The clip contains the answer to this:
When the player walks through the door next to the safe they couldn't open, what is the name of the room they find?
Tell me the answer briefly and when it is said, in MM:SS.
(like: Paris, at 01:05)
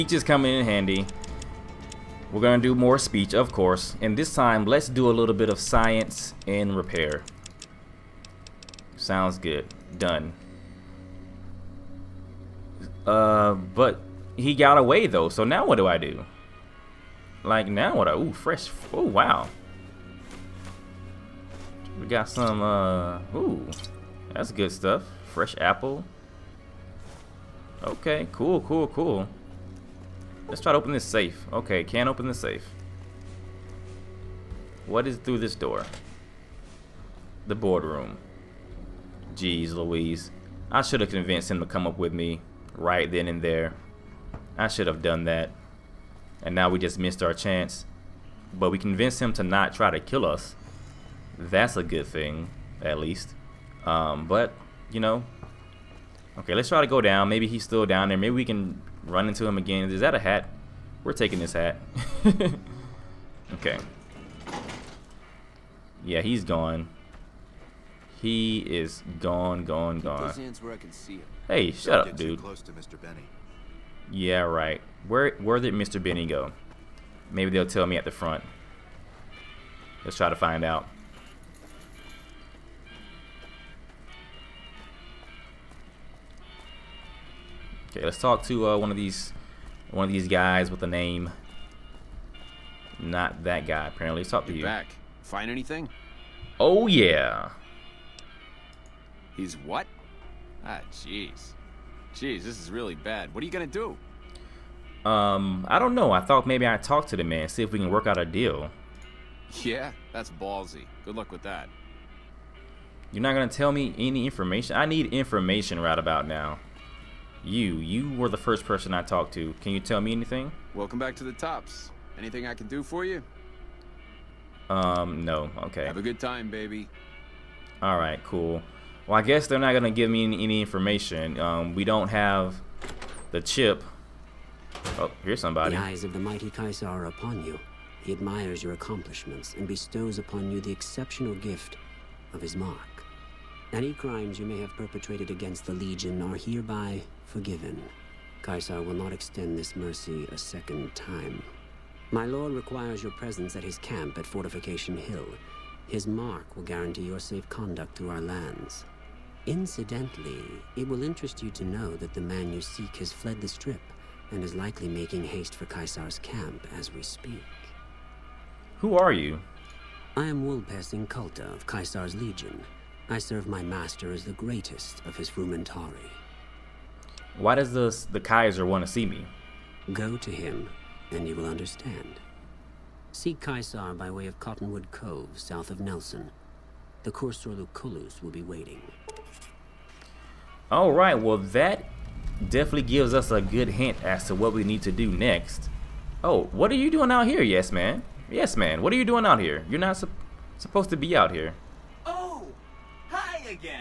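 The boardroom, at 00:37.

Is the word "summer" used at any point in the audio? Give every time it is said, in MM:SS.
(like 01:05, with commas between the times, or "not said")
not said.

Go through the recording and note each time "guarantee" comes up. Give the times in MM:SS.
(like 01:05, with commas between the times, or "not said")
02:36.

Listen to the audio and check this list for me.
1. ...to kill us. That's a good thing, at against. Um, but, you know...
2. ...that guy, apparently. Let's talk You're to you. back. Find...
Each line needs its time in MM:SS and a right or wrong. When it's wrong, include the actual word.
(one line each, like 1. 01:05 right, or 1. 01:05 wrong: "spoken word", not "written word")
1. 00:49 wrong: "least", not "against"
2. 01:33 right.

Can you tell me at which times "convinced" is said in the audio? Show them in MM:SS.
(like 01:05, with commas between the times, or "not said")
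00:41, 00:48.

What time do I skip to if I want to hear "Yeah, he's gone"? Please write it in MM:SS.
01:06.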